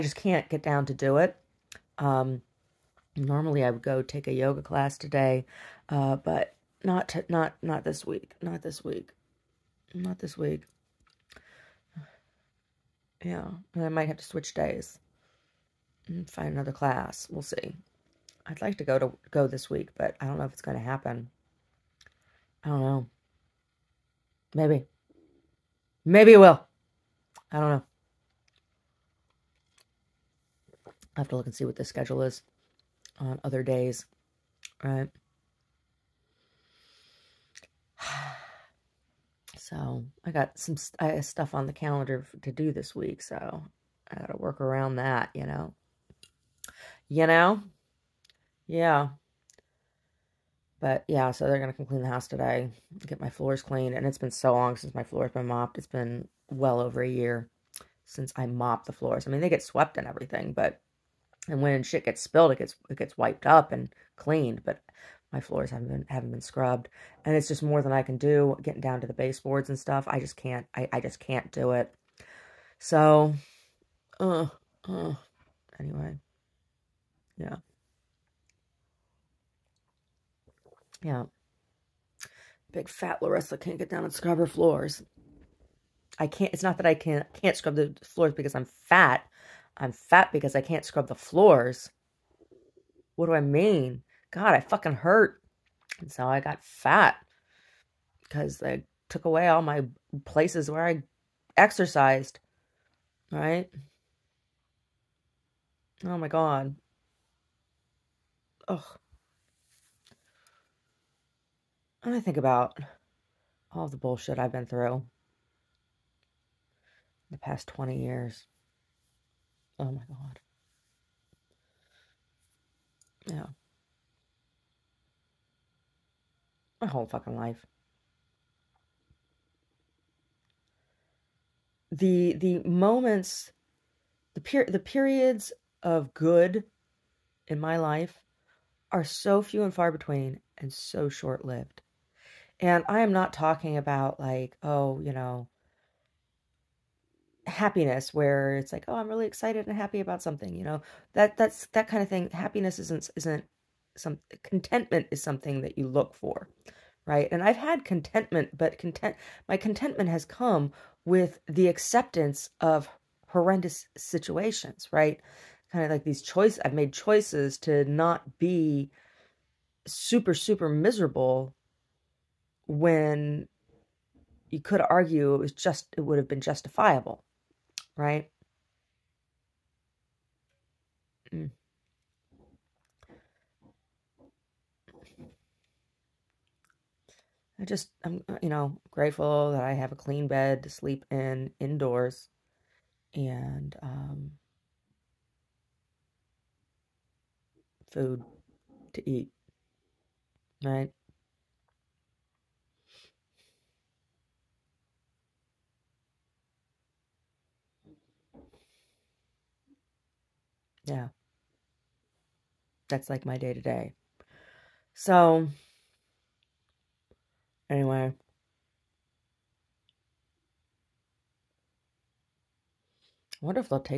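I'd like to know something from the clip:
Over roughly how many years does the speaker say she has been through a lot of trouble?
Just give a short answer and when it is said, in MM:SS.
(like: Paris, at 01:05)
20 years, at 01:57.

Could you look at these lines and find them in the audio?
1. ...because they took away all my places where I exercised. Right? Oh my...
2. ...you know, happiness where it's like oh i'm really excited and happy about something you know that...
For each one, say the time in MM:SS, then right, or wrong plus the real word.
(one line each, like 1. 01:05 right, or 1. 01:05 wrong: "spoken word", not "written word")
1. 01:38 right
2. 02:25 right.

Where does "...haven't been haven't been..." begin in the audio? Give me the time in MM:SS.
01:05.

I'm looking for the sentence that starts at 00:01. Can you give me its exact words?
Um, normally I would go take a yoga class today, uh, but not to, not not this week.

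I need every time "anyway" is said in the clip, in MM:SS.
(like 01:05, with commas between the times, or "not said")
01:15, 03:37.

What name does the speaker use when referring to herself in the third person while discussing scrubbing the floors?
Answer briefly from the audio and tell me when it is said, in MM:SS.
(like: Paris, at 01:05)
Larissa, at 01:23.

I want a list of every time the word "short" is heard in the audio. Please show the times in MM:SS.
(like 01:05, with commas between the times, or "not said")
02:21.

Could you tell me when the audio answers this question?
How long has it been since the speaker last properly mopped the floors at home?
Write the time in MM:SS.
00:56.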